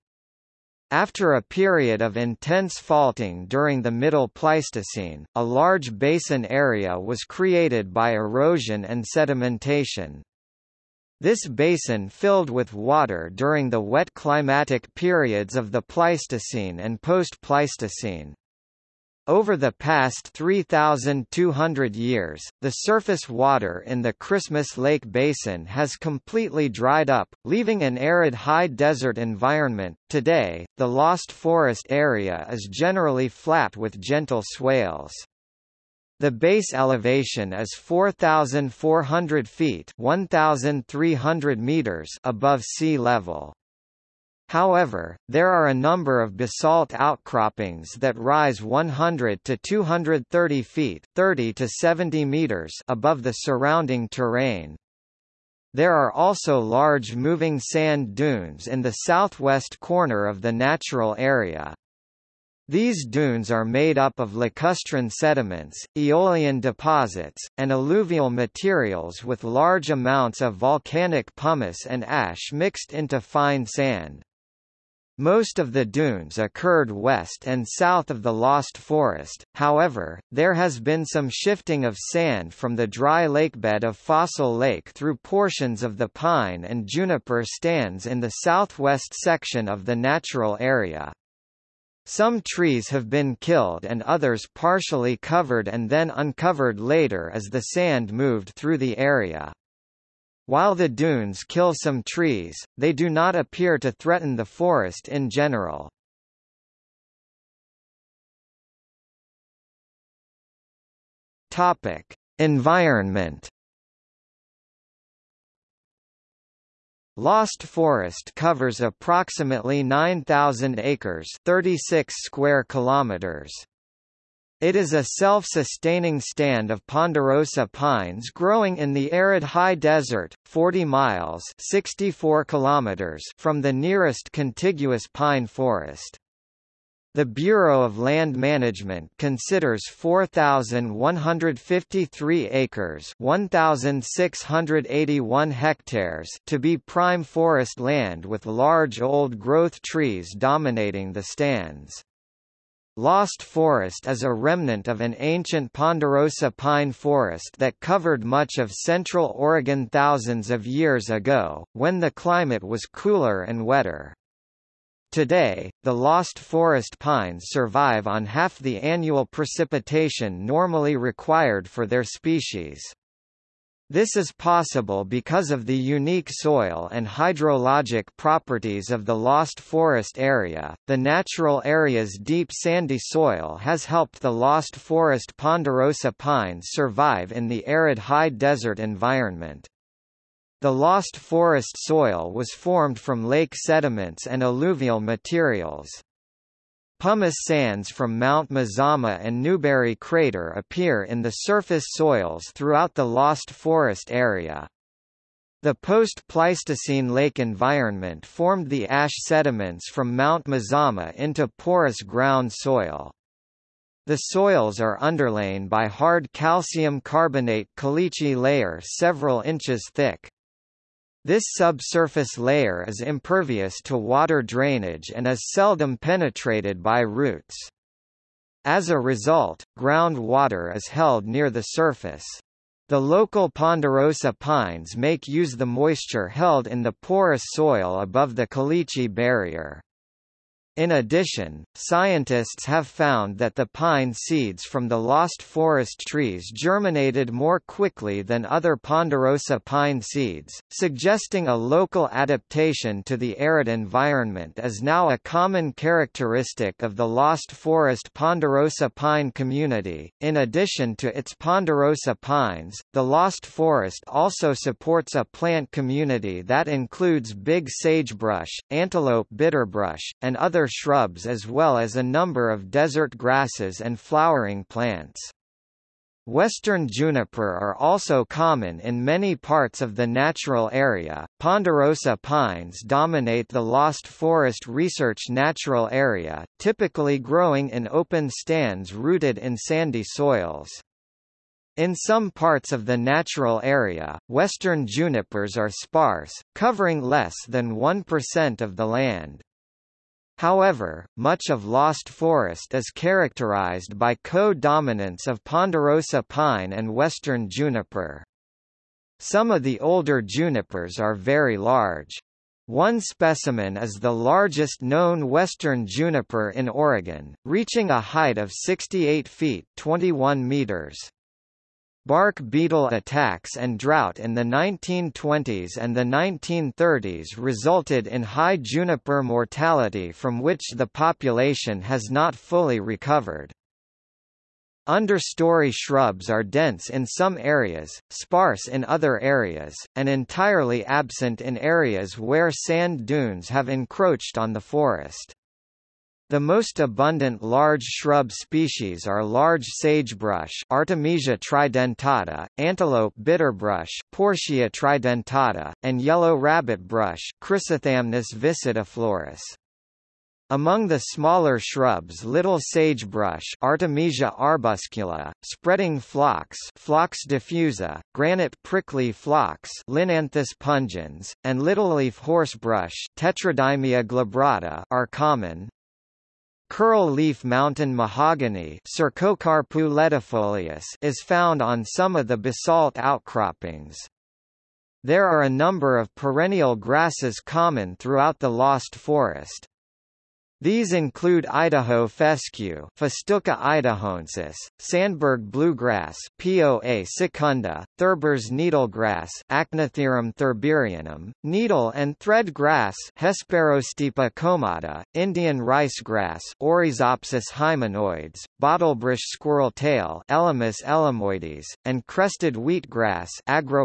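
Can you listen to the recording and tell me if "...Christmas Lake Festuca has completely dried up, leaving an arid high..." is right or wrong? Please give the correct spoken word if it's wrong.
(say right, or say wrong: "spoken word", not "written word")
wrong: "Basin", not "Festuca".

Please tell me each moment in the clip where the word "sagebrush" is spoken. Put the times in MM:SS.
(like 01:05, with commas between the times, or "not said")
04:27, 05:49, 06:02.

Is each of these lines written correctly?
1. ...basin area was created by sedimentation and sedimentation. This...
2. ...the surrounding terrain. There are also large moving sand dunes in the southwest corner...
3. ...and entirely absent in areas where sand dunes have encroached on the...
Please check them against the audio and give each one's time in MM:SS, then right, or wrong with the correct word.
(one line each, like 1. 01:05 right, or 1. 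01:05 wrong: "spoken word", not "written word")
1. 00:05 wrong: "erosion", not "sedimentation"
2. 00:53 right
3. 05:39 right.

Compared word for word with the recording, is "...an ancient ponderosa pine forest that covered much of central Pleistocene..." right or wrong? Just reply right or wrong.
wrong.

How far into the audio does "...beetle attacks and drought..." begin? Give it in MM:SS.
05:22.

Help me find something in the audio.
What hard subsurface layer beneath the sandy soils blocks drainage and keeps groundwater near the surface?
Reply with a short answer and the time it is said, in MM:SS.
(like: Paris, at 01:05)
calcium carbonate caliche, at 03:36.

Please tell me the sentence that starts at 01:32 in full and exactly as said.
Some trees have been killed and others partially covered and then uncovered later as the sand moved through the area.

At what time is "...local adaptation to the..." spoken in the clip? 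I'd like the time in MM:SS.
04:11.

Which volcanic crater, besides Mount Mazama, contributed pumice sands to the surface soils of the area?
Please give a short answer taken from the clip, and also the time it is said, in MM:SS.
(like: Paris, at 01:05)
Newberry Crater, at 03:19.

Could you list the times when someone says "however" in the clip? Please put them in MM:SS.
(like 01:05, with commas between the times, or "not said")
00:44, 01:19, 05:00.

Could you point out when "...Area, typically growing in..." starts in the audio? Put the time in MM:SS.
04:45.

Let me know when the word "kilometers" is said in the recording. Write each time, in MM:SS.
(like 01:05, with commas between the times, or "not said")
02:02, 02:12.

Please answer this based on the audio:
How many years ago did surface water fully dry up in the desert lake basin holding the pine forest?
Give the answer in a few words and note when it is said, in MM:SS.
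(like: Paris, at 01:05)
3,200 years, at 00:20.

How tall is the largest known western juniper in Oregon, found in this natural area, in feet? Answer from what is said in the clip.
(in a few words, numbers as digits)
68 feet.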